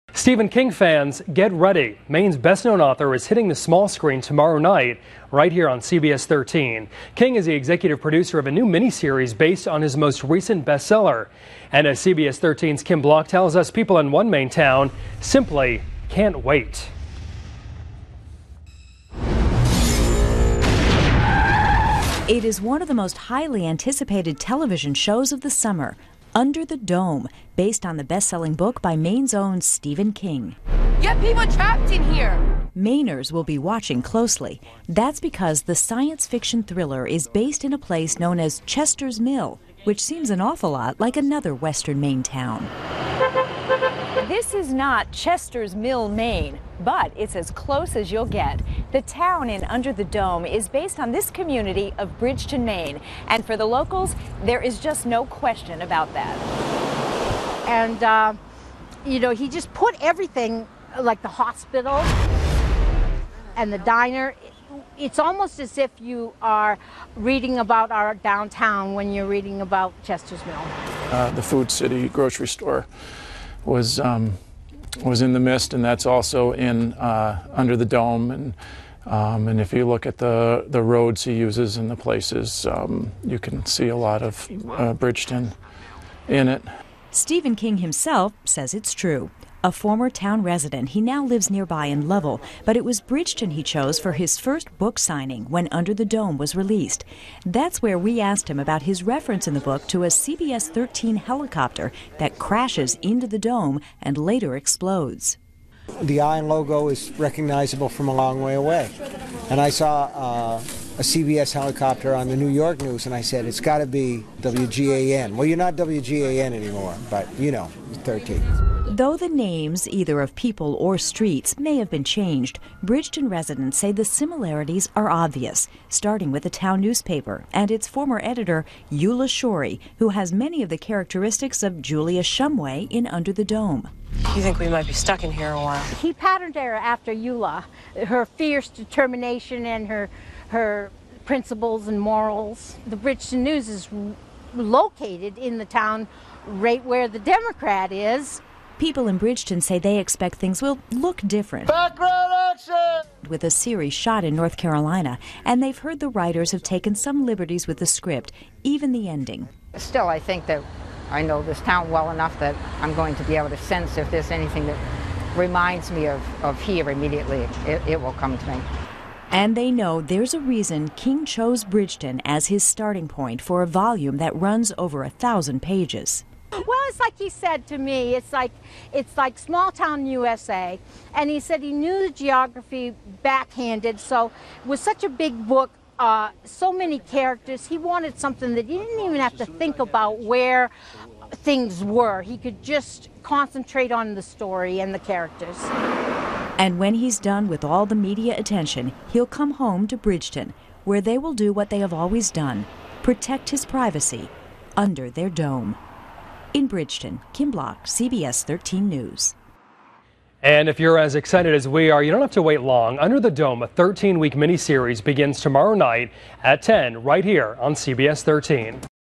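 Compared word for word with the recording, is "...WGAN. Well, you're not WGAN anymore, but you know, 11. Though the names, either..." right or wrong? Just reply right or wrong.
wrong.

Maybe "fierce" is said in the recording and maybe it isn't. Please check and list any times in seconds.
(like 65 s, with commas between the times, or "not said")
138 s.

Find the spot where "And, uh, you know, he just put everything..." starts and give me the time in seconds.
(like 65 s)
57 s.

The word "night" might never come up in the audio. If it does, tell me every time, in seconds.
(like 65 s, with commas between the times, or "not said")
4 s, 215 s.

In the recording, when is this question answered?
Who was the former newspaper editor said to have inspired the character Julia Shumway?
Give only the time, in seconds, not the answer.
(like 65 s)
128 s.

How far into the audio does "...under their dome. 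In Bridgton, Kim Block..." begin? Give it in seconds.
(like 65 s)
204 s.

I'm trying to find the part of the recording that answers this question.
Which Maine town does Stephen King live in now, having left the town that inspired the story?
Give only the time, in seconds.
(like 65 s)
92 s.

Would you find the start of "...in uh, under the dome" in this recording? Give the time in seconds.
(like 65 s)
76 s.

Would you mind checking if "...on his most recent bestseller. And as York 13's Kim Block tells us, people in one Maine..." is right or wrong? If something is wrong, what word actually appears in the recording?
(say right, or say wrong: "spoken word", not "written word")
wrong: "CBS", not "York".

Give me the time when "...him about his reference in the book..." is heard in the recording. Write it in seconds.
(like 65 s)
98 s.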